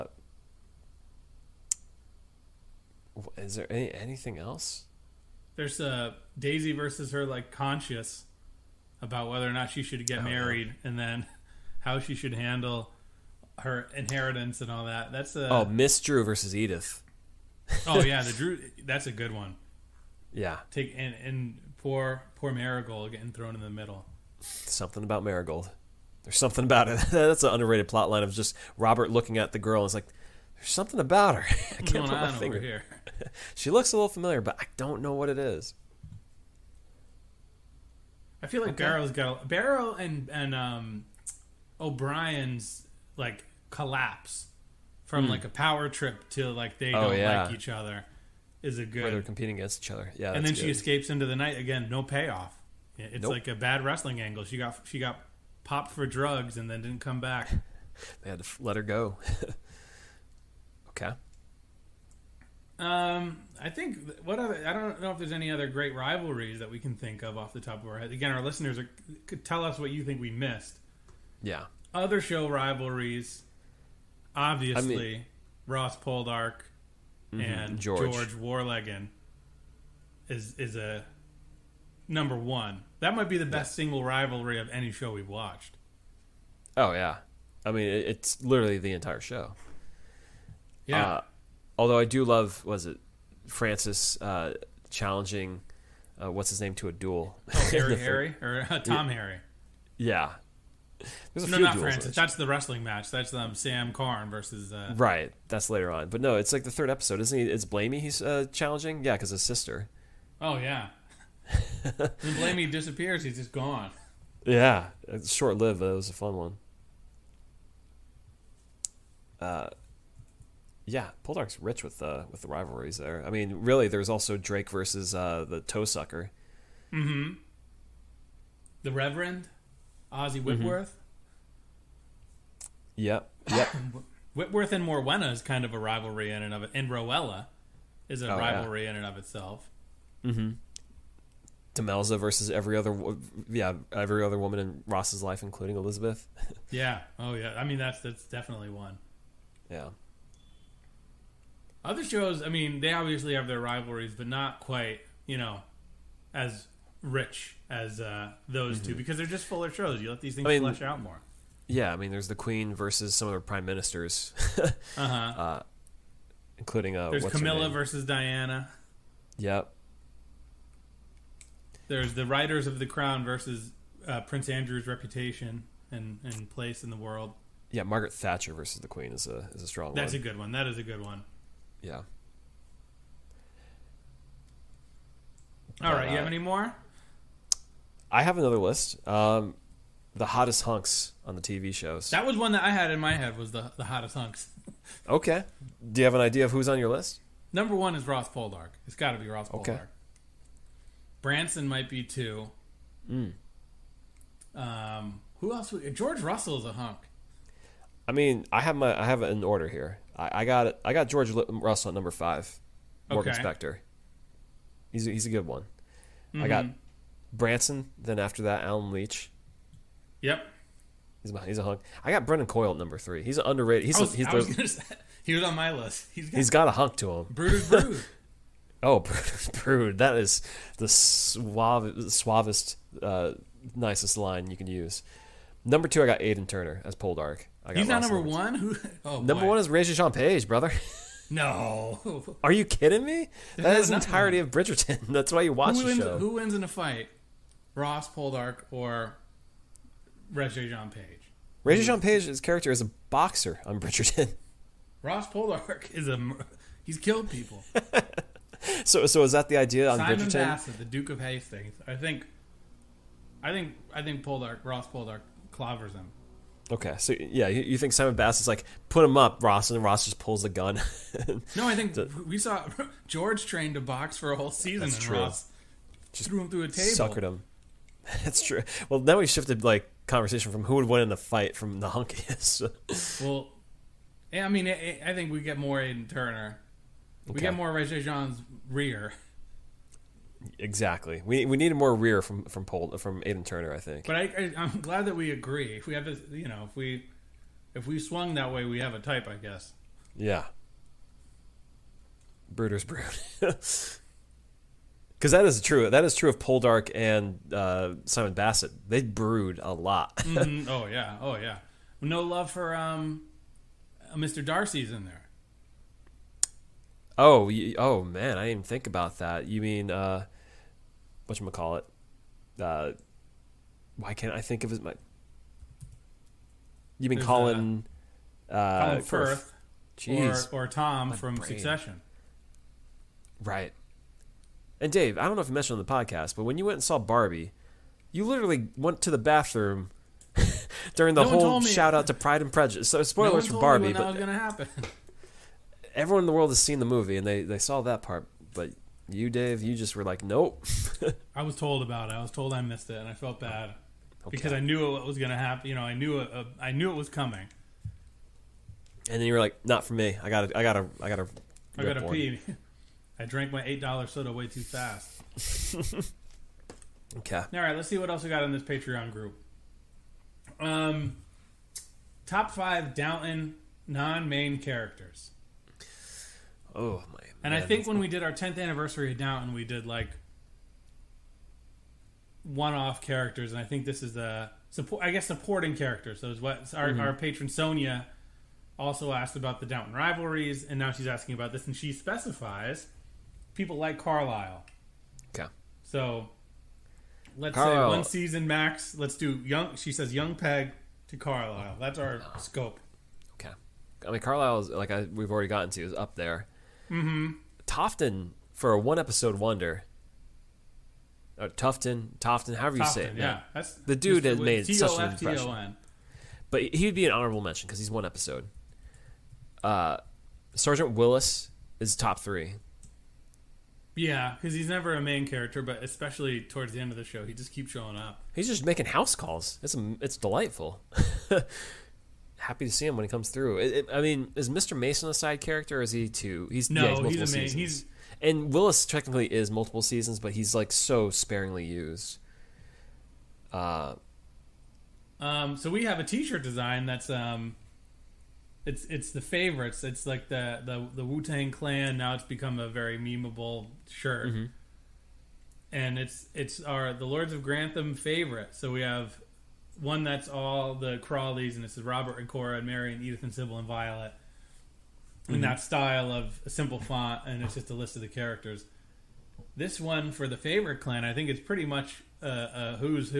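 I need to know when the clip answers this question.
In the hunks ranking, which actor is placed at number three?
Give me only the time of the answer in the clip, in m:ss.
3:42.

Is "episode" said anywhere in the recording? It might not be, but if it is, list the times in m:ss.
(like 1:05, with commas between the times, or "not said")
1:46, 6:48, 6:58.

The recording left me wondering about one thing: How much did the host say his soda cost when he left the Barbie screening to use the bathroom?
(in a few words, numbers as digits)
$8.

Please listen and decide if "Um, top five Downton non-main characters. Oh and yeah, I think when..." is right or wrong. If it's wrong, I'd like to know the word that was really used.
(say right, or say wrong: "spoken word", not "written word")
right.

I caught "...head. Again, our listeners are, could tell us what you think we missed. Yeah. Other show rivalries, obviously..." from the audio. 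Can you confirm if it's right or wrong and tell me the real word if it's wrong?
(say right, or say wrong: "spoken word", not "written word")
right.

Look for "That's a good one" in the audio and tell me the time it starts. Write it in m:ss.
0:18.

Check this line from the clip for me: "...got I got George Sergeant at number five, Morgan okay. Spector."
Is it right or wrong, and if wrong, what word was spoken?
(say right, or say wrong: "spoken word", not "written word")
wrong: "Russell", not "Sergeant".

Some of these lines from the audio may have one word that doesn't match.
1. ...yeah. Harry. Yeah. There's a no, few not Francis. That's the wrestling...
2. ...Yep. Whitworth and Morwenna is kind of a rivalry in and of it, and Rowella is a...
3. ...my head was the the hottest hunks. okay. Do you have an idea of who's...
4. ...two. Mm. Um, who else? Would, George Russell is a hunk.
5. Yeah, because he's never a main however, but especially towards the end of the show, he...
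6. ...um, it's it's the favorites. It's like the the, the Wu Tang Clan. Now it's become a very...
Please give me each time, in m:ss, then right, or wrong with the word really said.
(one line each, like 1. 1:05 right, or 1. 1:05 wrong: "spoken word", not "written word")
1. 1:39 right
2. 2:13 right
3. 3:12 right
4. 3:22 right
5. 7:03 wrong: "character", not "however"
6. 7:27 right.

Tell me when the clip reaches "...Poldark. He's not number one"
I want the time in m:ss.
3:56.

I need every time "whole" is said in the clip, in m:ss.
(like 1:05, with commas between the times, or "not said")
4:34, 5:41.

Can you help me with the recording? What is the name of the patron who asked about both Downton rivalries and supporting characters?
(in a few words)
Sonia.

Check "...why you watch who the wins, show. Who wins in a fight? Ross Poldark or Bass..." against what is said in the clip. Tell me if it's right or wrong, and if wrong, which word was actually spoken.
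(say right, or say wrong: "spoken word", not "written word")
wrong: "Reggie", not "Bass".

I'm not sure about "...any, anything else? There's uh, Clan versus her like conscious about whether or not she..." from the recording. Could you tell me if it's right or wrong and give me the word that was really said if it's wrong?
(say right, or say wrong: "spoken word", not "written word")
wrong: "Daisy", not "Clan".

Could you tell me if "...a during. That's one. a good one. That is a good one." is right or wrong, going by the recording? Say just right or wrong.
wrong.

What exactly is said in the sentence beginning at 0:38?
Barrow's got a, Barrow and and um, O'Brien's like collapse from mm.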